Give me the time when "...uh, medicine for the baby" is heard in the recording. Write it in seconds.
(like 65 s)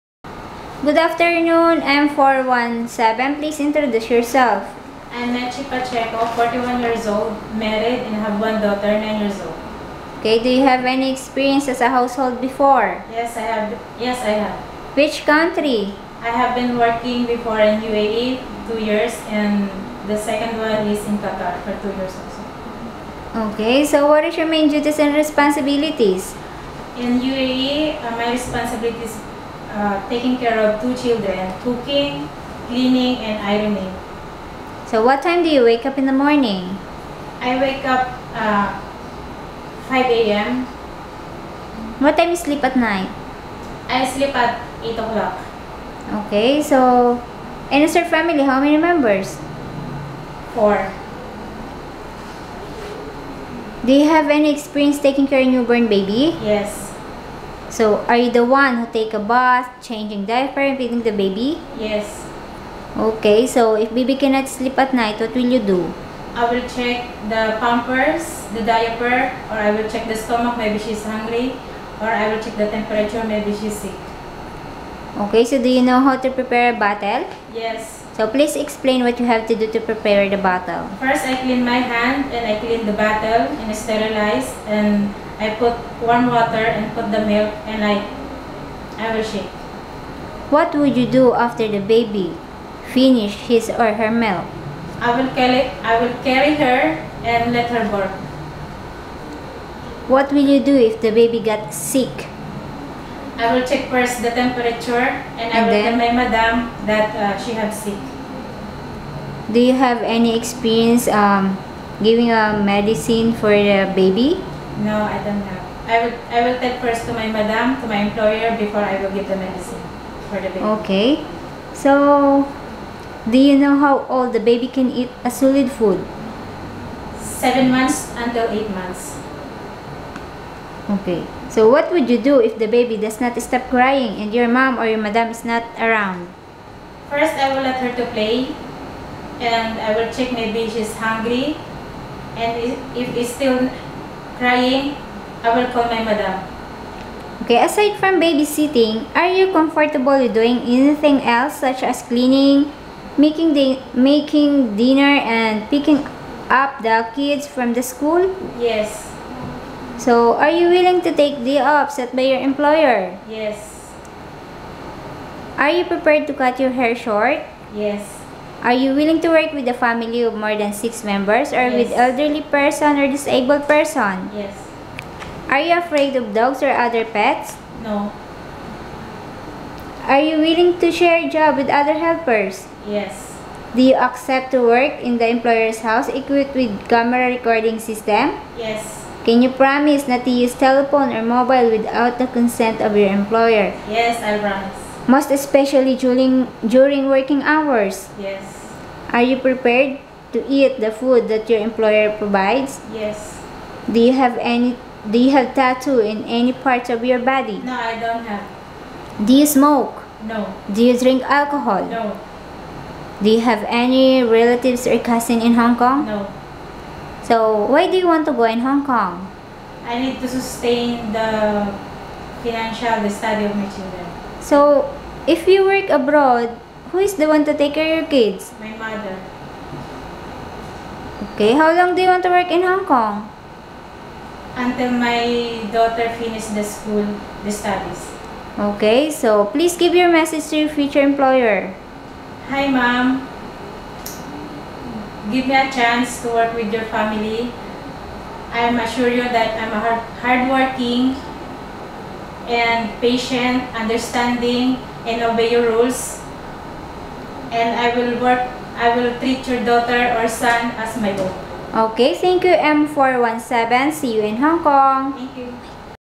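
112 s.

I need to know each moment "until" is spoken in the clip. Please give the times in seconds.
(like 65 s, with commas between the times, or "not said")
128 s, 234 s.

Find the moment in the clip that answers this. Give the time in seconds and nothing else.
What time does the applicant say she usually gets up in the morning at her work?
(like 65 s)
39 s.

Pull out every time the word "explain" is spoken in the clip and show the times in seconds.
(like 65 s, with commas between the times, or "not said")
78 s.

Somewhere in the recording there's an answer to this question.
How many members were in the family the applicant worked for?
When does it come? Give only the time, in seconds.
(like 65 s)
50 s.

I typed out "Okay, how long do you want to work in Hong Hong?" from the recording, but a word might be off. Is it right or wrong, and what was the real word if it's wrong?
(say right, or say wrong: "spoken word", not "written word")
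wrong: "Kong", not "Hong".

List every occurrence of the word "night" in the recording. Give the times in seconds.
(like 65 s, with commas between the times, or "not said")
42 s, 64 s.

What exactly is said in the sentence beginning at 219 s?
I need to sustain the financial the study of my children.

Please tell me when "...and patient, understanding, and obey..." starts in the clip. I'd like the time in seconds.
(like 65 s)
252 s.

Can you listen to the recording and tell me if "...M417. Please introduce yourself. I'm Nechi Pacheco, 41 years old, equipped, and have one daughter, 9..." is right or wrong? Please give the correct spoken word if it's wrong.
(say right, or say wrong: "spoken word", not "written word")
wrong: "married", not "equipped".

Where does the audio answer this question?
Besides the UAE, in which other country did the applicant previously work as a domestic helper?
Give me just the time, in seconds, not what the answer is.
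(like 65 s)
21 s.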